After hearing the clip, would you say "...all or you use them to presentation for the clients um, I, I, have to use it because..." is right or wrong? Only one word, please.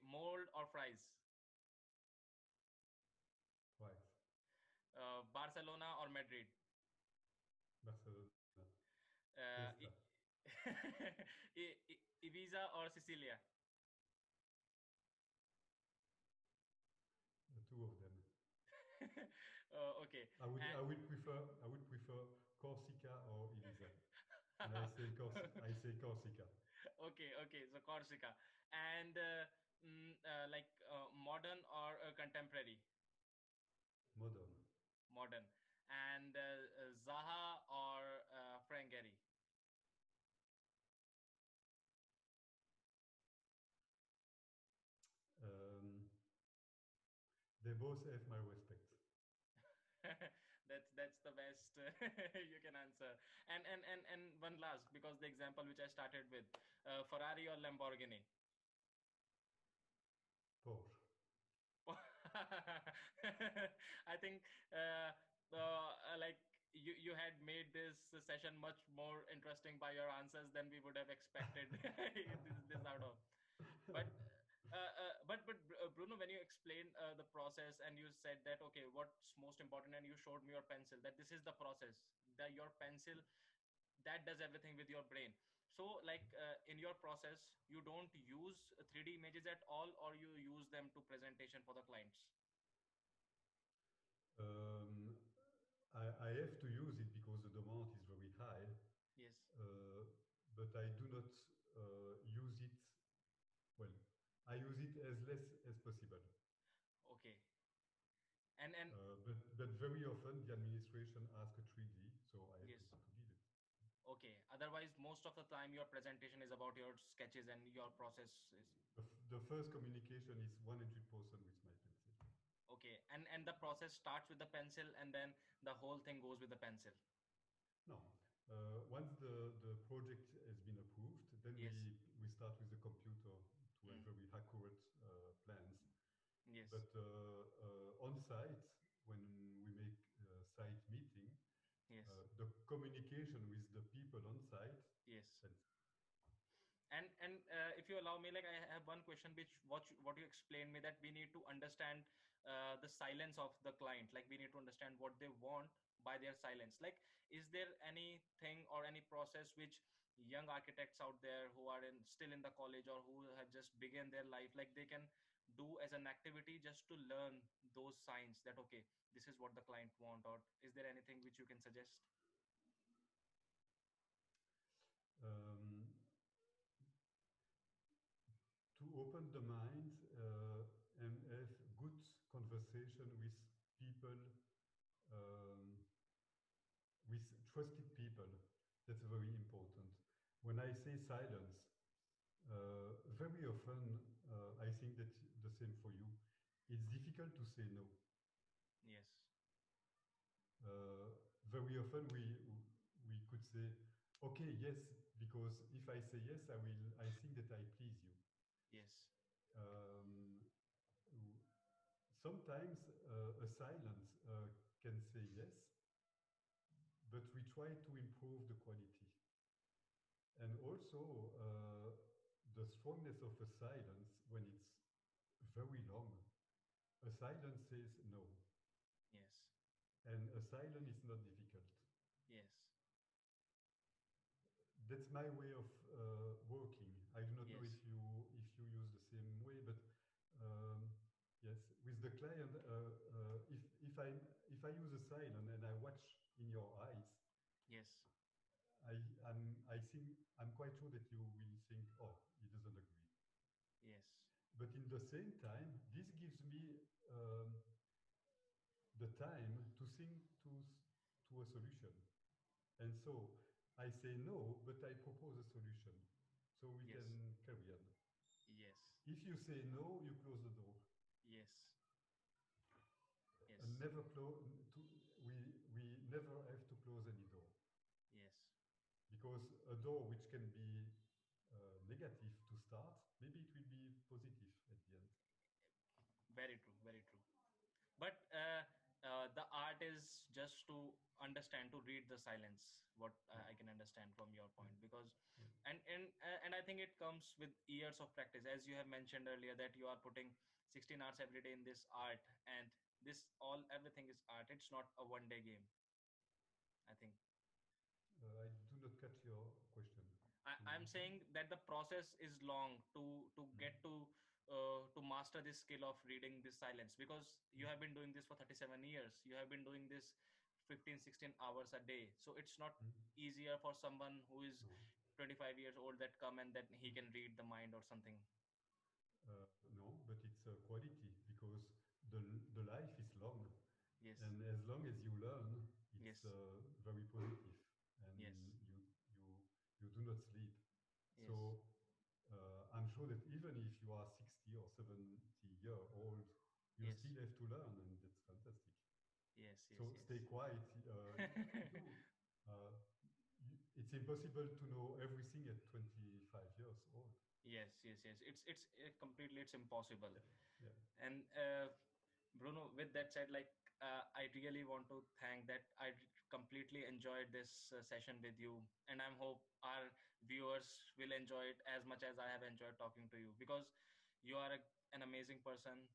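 right.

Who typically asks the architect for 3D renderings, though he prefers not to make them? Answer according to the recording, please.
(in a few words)
the administration.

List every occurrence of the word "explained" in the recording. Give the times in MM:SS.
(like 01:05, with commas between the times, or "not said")
01:16, 02:30.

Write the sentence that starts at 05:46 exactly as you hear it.
still have to learn, and that's fantastic.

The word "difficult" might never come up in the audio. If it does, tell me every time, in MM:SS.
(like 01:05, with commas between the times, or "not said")
03:16, 03:51.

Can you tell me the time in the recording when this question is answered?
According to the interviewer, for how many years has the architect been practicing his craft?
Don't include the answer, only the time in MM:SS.
05:18.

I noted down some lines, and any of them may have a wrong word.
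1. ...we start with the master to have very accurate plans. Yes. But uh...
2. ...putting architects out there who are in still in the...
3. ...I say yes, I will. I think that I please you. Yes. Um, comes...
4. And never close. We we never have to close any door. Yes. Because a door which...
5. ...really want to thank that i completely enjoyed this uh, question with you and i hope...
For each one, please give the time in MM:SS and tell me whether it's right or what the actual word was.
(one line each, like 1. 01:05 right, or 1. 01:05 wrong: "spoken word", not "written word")
1. 02:12 wrong: "computer", not "master"
2. 02:40 wrong: "young", not "putting"
3. 03:25 wrong: "sometimes", not "comes"
4. 04:33 right
5. 06:04 wrong: "session", not "question".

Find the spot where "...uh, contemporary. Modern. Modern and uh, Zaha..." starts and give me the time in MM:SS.
00:32.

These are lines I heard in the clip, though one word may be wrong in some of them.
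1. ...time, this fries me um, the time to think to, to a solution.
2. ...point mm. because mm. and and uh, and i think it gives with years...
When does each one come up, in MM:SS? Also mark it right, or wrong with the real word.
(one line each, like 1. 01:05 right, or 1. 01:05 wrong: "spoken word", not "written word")
1. 04:15 wrong: "gives", not "fries"
2. 04:54 wrong: "comes", not "gives".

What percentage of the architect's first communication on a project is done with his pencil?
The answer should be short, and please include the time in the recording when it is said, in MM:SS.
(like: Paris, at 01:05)
100%, at 02:00.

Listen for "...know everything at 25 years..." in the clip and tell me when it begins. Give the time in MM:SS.
05:54.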